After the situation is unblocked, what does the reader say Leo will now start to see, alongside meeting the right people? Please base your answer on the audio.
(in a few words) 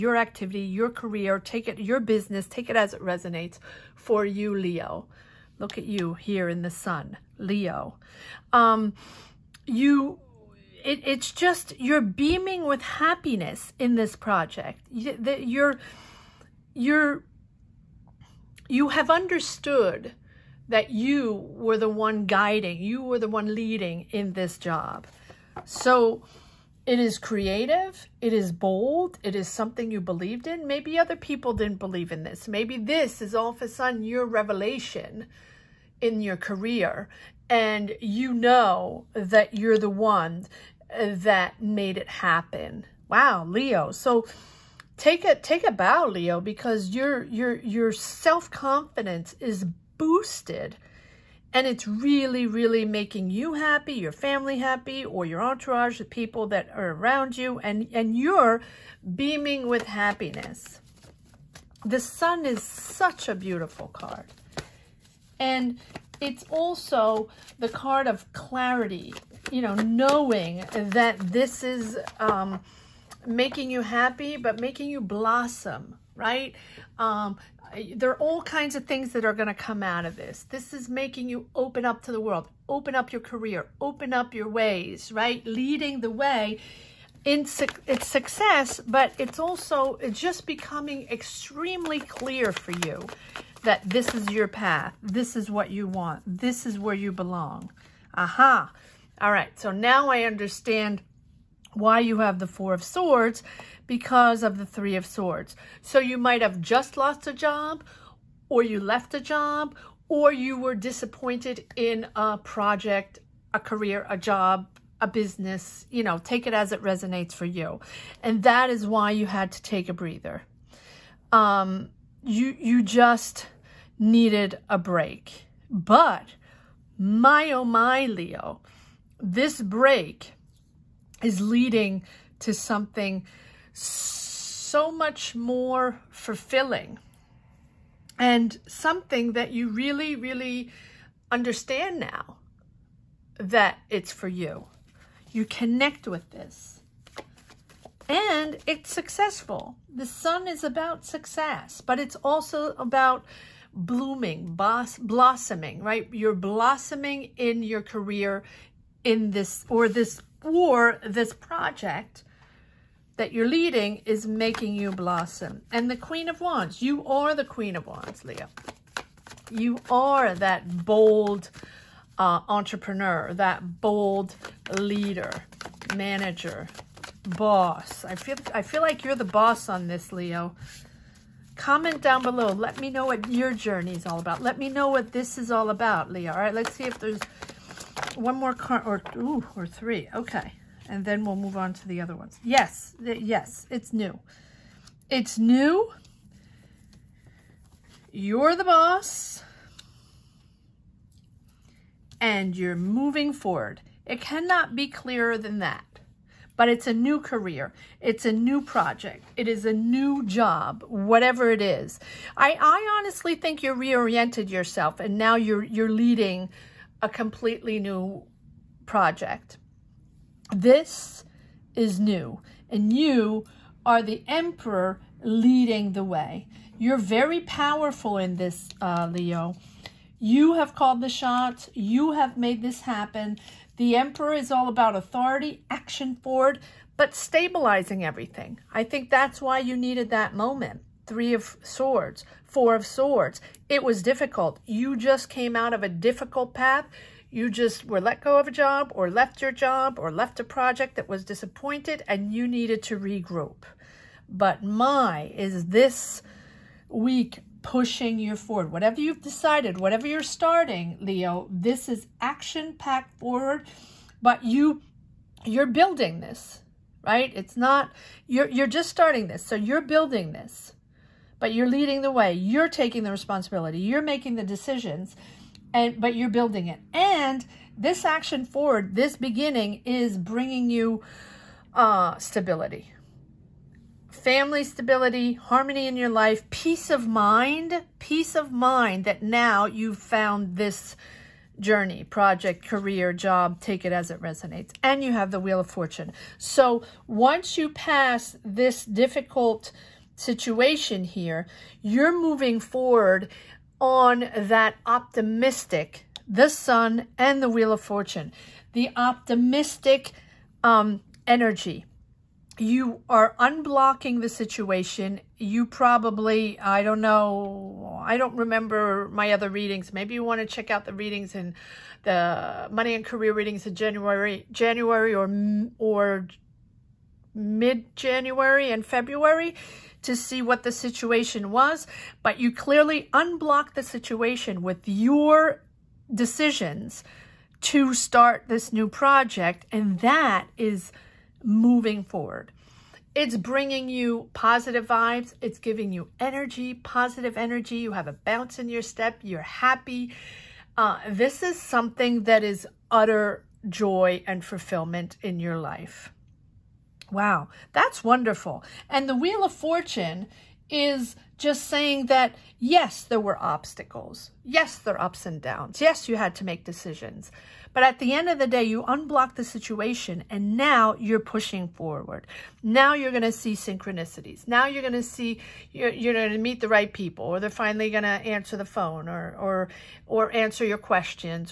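Synchronicities.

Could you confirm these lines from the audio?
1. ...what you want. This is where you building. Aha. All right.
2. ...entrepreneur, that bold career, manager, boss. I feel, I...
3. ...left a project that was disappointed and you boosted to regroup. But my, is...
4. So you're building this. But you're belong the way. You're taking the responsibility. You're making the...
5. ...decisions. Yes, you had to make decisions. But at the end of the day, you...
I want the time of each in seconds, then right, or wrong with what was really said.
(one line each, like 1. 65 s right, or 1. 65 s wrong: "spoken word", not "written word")
1. 95 s wrong: "belong", not "building"
2. 172 s wrong: "leader", not "career"
3. 250 s wrong: "needed", not "boosted"
4. 269 s wrong: "leading", not "belong"
5. 365 s wrong: "downs", not "decisions".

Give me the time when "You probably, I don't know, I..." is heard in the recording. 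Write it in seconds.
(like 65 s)
315 s.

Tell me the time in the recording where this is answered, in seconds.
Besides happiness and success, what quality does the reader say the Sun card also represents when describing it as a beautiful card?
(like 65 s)
68 s.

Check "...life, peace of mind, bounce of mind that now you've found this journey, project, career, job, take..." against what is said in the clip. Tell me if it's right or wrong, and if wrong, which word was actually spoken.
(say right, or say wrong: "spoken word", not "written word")
wrong: "peace", not "bounce".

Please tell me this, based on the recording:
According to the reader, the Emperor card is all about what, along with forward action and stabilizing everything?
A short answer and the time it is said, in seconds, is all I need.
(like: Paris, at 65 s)
Authority, at 234 s.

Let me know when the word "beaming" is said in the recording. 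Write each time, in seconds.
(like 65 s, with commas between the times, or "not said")
12 s, 59 s.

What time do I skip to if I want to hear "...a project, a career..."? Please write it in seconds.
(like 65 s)
112 s.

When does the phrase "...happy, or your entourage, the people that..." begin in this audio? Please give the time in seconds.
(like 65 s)
54 s.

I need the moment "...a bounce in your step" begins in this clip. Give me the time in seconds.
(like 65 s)
348 s.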